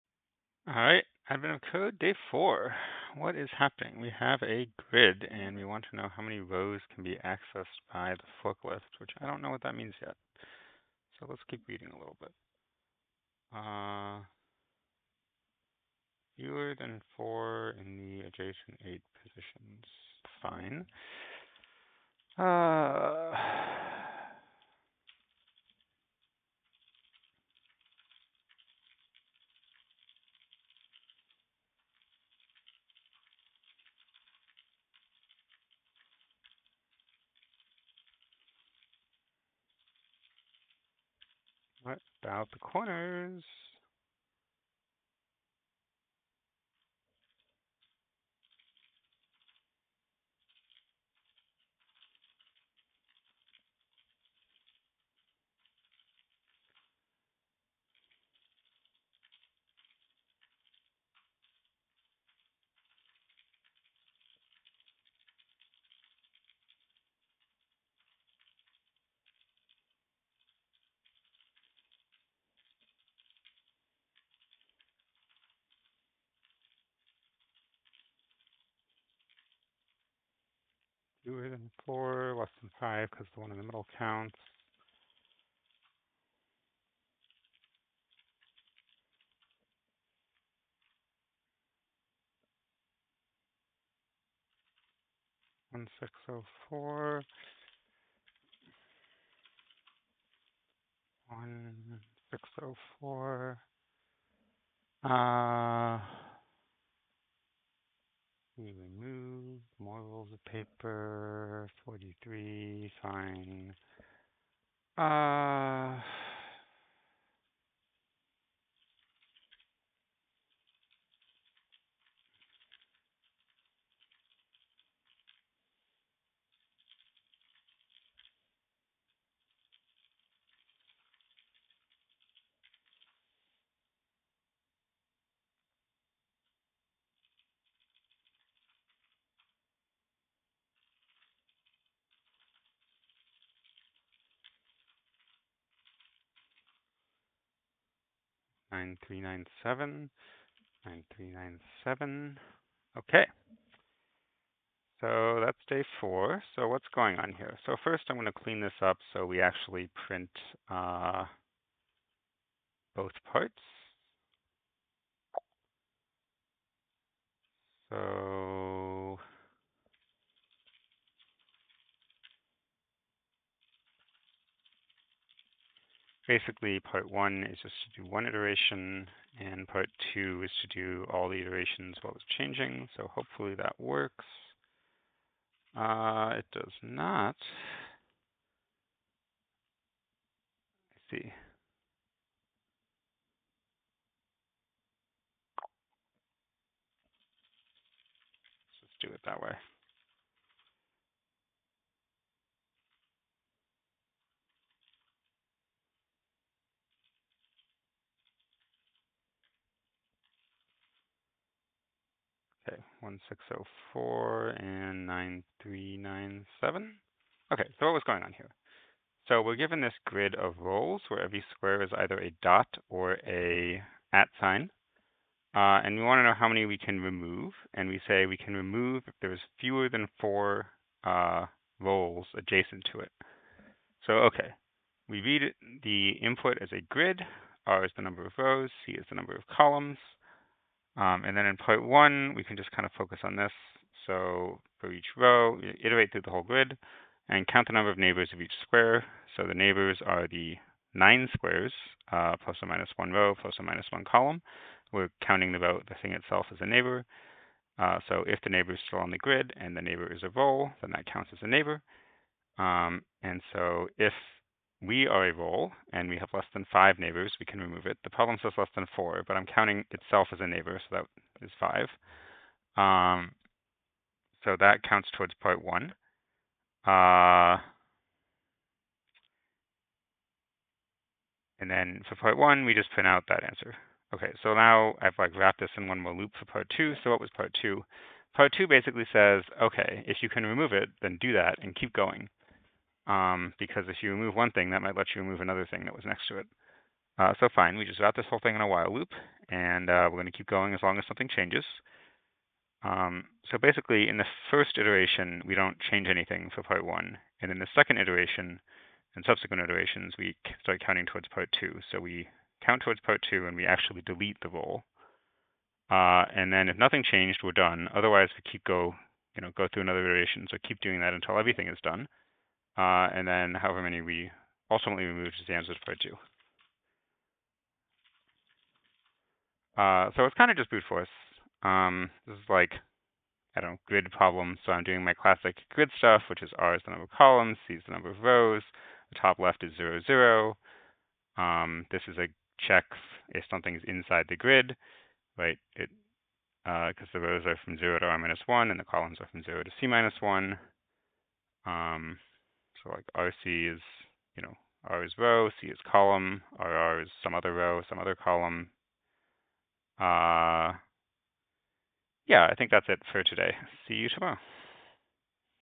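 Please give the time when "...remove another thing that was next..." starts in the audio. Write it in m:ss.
4:55.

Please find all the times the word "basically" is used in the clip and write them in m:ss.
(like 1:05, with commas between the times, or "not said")
2:56, 4:48, 5:03.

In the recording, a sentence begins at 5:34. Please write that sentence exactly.
So I'm doing my classic grid stuff, which is R is the number of columns, C is the number of rows.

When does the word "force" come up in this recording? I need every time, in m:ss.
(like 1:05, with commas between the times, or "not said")
5:30.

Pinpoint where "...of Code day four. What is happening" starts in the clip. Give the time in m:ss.
0:01.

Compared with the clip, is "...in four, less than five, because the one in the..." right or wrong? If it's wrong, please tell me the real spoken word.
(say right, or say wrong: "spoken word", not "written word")
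right.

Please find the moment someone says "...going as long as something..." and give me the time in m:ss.
5:00.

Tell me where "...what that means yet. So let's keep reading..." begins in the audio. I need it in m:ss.
0:09.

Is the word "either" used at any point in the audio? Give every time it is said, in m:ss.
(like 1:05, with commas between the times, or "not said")
3:41.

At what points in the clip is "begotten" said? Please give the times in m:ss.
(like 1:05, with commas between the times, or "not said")
not said.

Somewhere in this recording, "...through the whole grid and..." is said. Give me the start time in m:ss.
4:06.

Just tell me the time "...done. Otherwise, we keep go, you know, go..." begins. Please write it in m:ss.
5:17.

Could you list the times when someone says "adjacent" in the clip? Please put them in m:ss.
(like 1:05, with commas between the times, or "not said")
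0:18, 3:52.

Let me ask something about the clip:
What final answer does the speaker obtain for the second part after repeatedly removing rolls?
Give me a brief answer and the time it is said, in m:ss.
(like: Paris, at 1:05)
9397, at 2:28.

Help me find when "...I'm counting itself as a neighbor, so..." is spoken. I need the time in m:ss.
4:29.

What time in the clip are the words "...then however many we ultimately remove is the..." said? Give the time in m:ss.
5:23.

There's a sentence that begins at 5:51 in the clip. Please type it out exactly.
Um, so like RC is, you know, R is row, C is column, RR is some other row, some other column.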